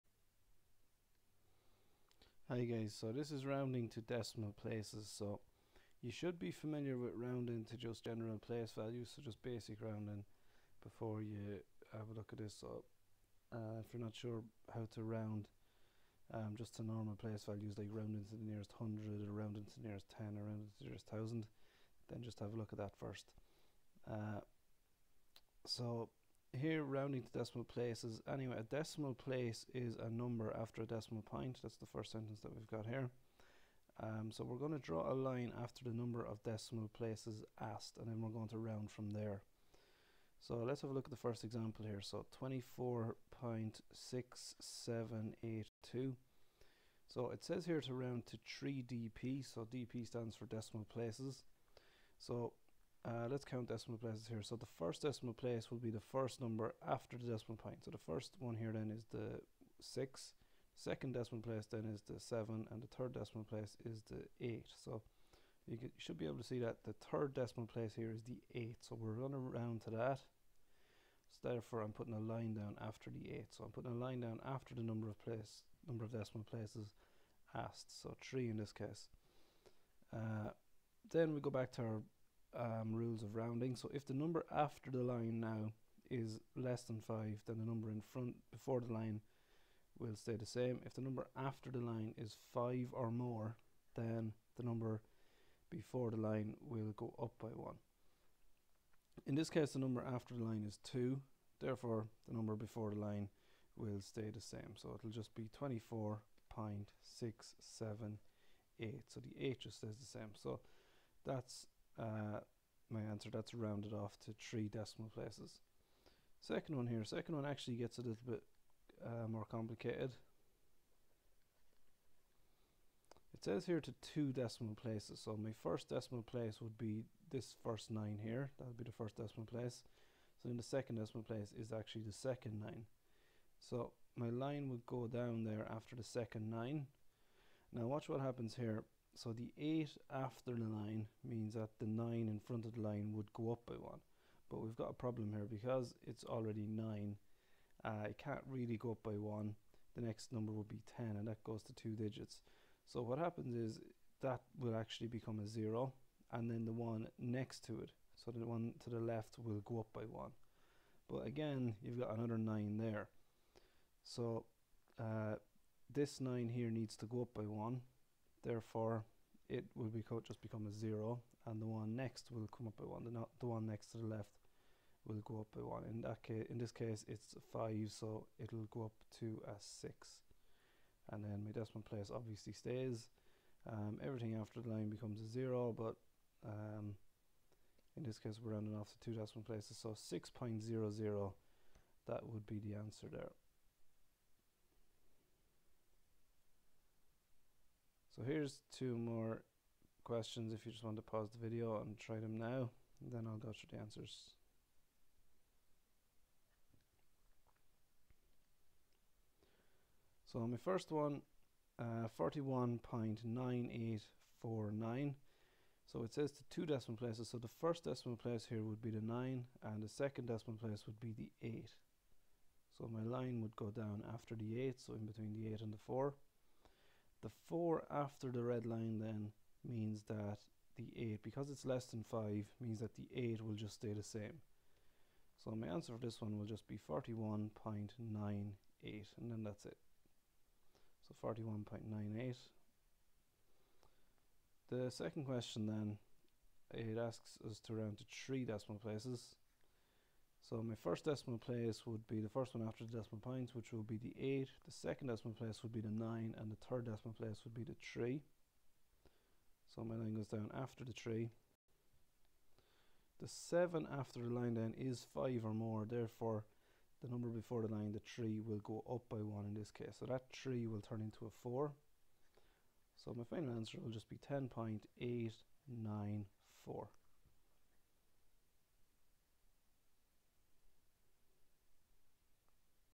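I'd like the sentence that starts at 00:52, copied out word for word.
So uh, let's count decimal places here.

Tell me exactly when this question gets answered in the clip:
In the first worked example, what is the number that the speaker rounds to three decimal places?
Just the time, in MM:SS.
00:42.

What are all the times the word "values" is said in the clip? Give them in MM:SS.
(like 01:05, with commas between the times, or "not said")
00:08, 00:17.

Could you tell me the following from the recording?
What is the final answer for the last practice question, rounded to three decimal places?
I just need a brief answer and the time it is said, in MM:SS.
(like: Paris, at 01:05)
10.894, at 04:34.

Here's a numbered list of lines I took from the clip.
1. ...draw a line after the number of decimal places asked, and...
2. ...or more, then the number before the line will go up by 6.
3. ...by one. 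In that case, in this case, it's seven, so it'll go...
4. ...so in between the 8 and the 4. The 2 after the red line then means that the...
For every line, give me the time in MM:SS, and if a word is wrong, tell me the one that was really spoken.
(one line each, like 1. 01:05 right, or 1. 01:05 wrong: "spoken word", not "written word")
1. 00:34 right
2. 01:32 wrong: "1", not "6"
3. 02:55 wrong: "five", not "seven"
4. 03:44 wrong: "4", not "2".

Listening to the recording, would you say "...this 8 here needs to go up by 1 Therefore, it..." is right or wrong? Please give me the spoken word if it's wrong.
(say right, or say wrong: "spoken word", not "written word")
wrong: "9", not "8".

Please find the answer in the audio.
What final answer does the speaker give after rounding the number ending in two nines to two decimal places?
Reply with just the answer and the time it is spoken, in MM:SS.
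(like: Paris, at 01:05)
6.00, at 03:09.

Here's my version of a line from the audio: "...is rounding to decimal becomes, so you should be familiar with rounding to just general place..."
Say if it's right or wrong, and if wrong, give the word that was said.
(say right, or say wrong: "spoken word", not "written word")
wrong: "places", not "becomes".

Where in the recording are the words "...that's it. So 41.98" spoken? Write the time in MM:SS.
03:59.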